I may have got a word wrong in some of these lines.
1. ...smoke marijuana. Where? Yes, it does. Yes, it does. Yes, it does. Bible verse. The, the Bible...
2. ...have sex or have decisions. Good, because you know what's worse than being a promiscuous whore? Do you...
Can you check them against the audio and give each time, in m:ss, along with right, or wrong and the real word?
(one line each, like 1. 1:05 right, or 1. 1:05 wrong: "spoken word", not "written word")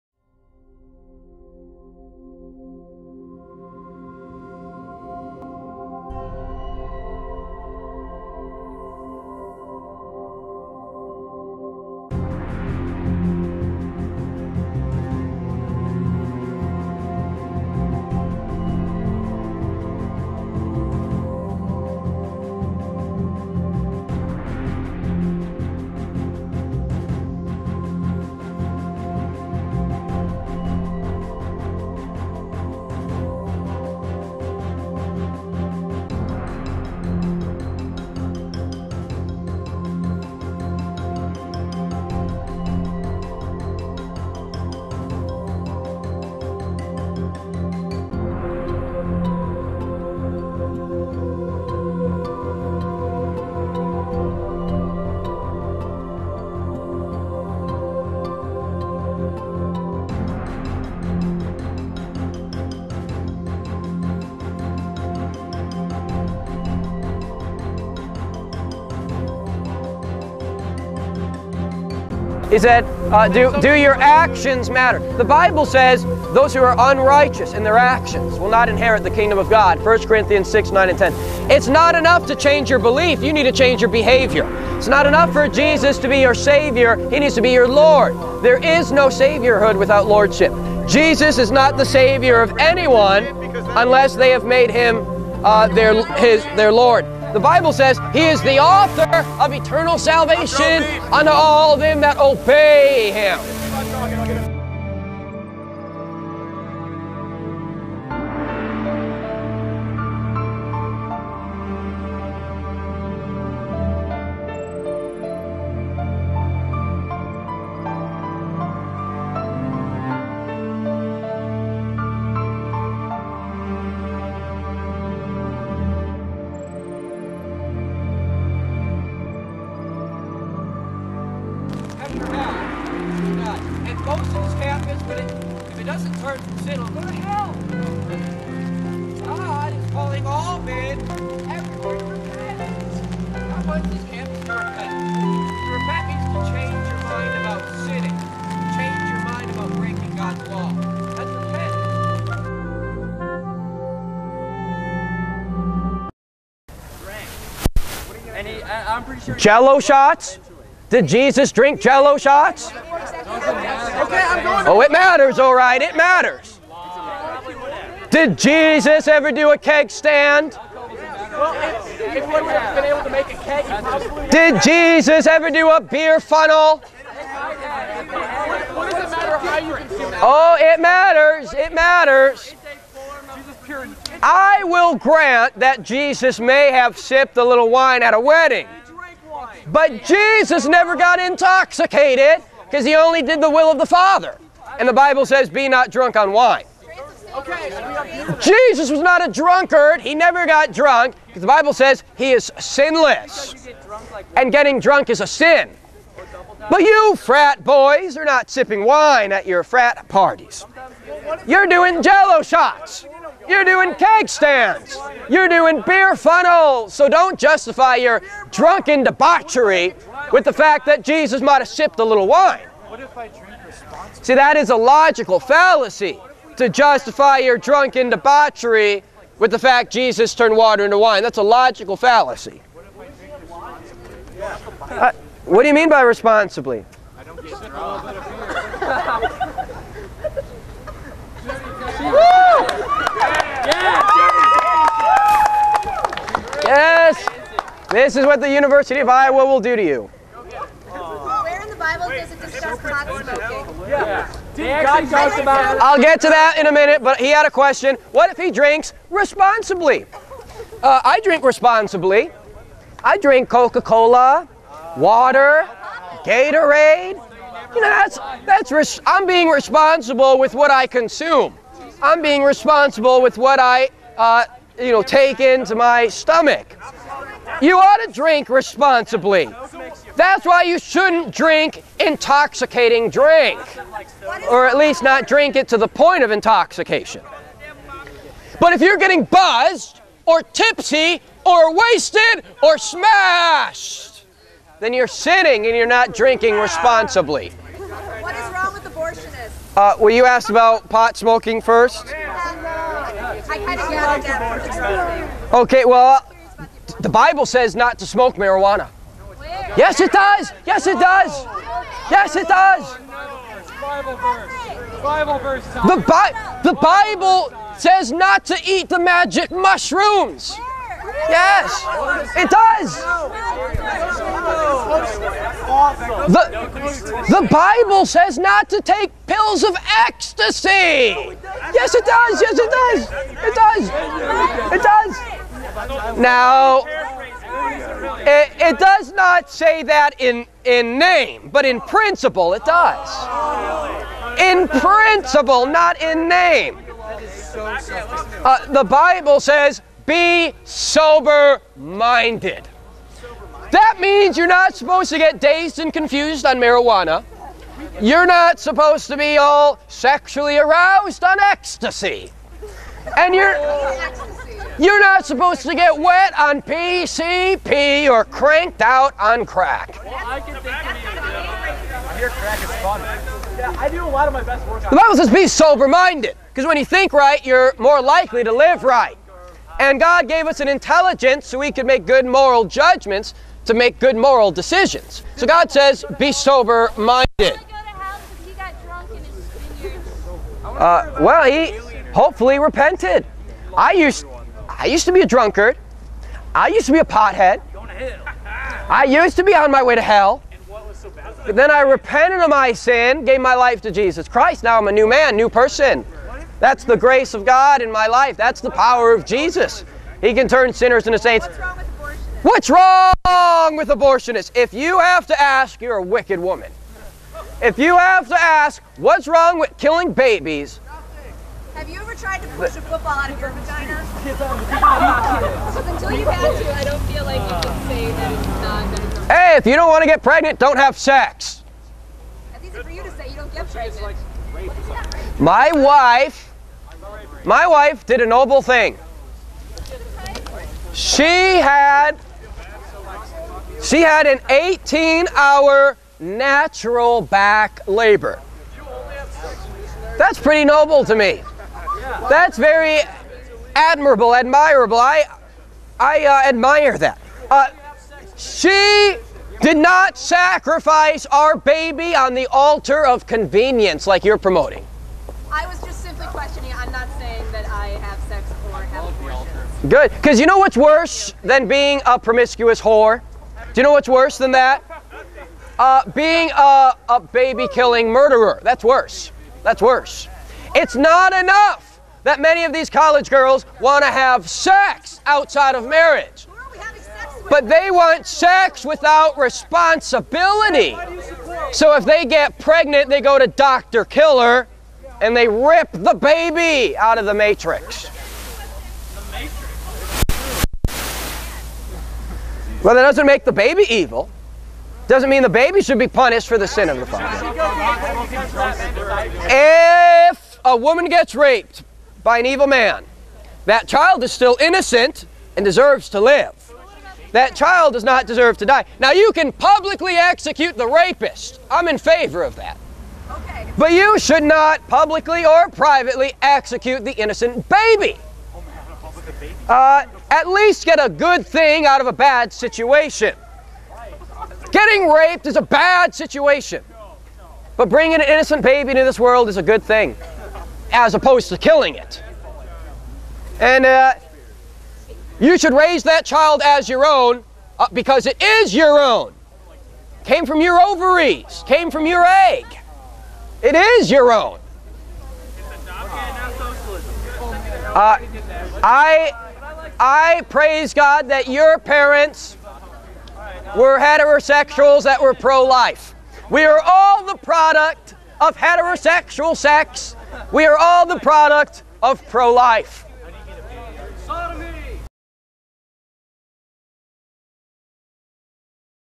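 1. 5:08 right
2. 7:47 wrong: "abortions", not "decisions".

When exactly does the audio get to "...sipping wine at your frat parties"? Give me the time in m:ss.
3:28.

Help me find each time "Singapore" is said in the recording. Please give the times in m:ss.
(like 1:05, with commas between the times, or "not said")
not said.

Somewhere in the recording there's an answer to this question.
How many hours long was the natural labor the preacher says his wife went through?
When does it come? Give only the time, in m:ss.
7:24.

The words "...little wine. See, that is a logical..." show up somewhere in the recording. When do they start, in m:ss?
3:42.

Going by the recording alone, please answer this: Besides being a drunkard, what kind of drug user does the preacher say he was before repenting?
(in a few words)
Pothead.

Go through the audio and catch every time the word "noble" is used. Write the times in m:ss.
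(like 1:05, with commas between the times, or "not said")
7:18, 7:30.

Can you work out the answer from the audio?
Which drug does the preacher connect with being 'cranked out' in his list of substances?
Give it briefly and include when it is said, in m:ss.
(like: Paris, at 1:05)
Crack, at 6:09.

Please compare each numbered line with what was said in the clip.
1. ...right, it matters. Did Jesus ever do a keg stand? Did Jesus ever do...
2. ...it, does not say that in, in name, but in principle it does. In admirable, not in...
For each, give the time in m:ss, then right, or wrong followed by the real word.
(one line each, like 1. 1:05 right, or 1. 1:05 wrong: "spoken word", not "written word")
1. 2:45 right
2. 5:38 wrong: "principle", not "admirable".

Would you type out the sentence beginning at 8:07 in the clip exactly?
But they want sex without responsibility.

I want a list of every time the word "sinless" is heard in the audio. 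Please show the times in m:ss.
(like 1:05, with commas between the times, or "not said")
3:22.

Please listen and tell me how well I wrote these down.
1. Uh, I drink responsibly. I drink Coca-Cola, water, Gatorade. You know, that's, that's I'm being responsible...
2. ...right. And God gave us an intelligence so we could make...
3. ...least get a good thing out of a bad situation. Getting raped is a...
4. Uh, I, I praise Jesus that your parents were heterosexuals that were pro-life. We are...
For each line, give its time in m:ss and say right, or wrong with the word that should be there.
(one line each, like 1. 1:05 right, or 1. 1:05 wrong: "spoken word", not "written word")
1. 4:20 right
2. 6:18 right
3. 8:50 right
4. 9:17 wrong: "God", not "Jesus".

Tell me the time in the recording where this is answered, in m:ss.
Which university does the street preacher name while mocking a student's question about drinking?
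4:08.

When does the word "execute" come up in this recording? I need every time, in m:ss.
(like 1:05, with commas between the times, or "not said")
8:40, 8:46.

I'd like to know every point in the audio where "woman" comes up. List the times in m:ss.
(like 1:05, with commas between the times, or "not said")
6:56, 8:30.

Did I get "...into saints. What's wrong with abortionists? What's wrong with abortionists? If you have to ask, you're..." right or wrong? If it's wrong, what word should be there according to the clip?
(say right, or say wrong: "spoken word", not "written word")
right.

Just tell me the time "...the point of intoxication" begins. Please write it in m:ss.
4:45.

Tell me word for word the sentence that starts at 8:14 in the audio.
Killer and they rip the baby out of the matrix.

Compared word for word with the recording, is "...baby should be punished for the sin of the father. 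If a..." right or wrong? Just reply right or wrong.
right.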